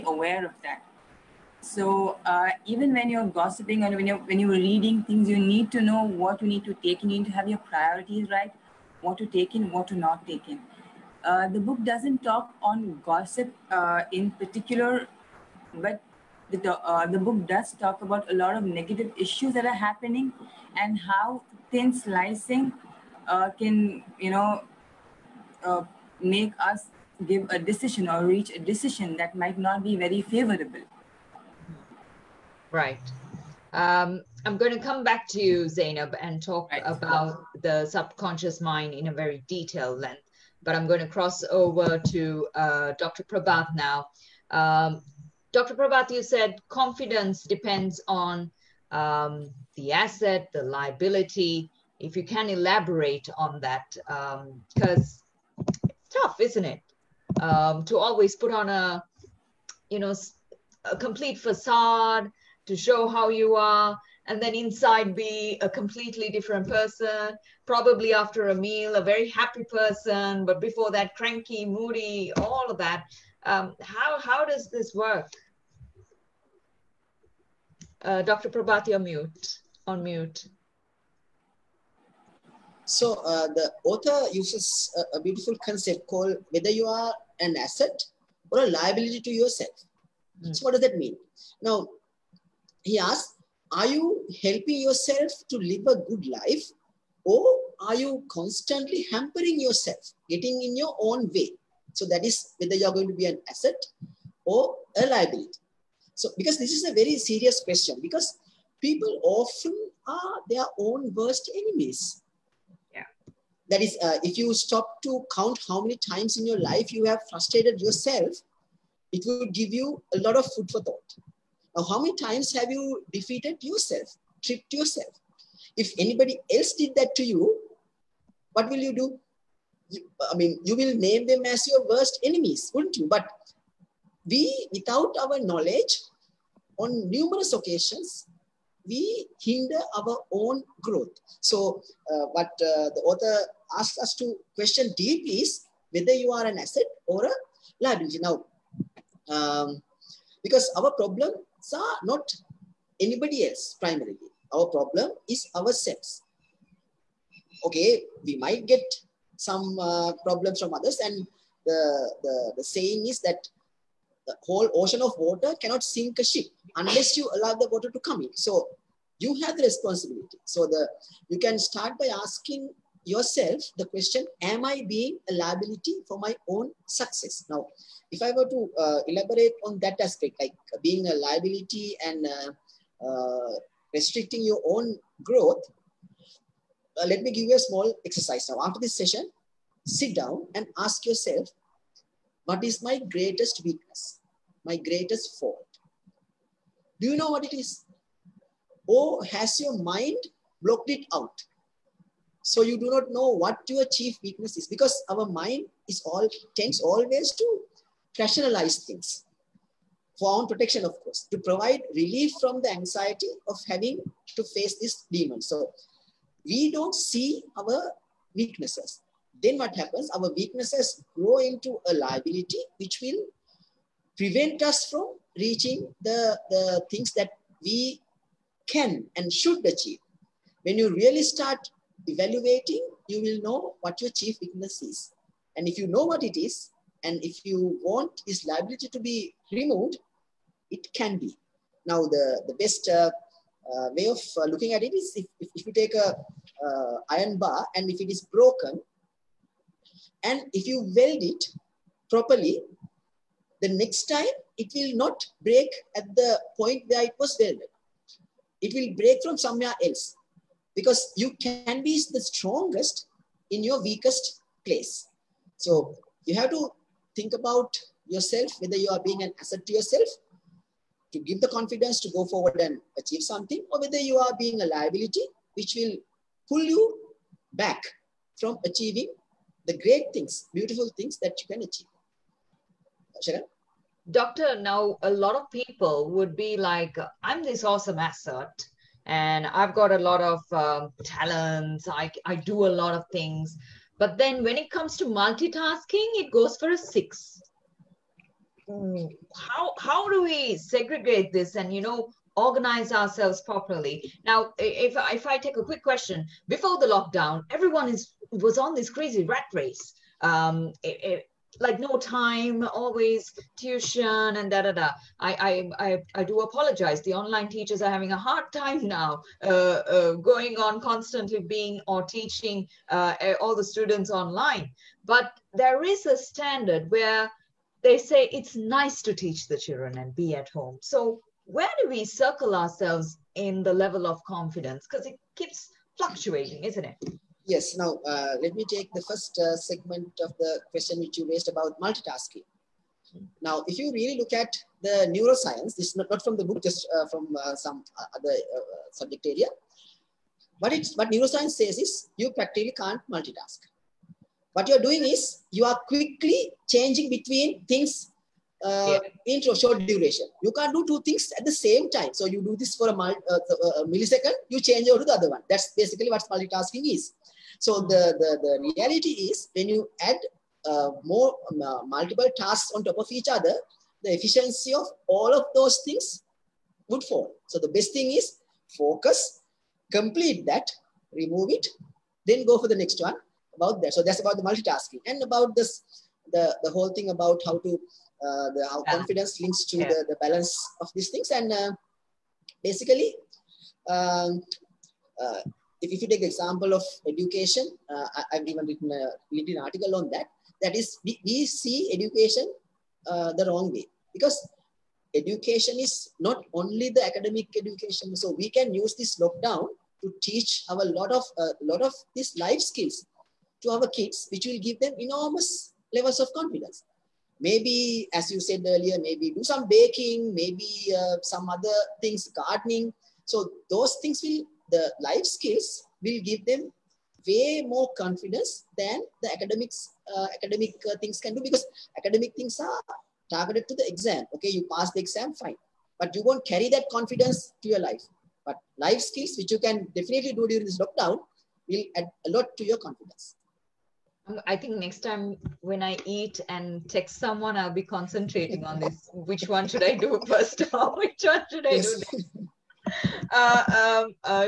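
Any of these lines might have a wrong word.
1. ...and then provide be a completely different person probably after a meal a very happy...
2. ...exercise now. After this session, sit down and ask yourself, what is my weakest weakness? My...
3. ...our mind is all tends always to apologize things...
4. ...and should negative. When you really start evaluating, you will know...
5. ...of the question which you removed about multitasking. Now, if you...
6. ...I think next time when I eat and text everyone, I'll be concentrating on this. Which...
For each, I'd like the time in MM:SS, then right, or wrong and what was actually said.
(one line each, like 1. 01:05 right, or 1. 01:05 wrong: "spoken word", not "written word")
1. 01:04 wrong: "inside", not "provide"
2. 03:08 wrong: "greatest", not "weakest"
3. 03:25 wrong: "rationalize", not "apologize"
4. 03:49 wrong: "achieve", not "negative"
5. 05:40 wrong: "raised", not "removed"
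6. 07:24 wrong: "someone", not "everyone".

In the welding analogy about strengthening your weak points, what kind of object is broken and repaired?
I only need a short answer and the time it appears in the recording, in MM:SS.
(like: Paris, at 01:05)
Iron bar, at 04:07.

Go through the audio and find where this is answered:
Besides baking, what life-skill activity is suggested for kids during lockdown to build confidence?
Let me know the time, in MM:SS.
07:02.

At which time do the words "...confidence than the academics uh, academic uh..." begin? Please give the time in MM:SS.
07:07.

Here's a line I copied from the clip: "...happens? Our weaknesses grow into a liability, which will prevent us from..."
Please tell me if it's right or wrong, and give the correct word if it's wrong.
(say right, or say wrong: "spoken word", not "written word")
right.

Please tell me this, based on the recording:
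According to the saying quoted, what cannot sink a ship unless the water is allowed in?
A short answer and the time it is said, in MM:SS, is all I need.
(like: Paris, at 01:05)
The whole ocean, at 02:44.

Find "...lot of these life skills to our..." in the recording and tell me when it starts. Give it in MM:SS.
06:51.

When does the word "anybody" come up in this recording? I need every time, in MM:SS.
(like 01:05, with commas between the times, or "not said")
02:05, 02:32.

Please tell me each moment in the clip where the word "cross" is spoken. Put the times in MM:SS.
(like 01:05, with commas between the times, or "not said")
00:41.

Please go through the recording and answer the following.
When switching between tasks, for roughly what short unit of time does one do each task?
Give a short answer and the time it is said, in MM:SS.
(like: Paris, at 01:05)
A millisecond, at 06:03.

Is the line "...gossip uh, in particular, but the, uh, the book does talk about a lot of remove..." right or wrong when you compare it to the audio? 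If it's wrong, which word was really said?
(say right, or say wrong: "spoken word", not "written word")
wrong: "negative", not "remove".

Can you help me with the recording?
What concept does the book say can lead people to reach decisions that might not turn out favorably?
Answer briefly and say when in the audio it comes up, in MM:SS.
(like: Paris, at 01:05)
Thin slicing, at 00:21.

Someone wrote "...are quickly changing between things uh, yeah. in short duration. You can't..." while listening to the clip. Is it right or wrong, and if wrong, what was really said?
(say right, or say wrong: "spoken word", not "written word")
right.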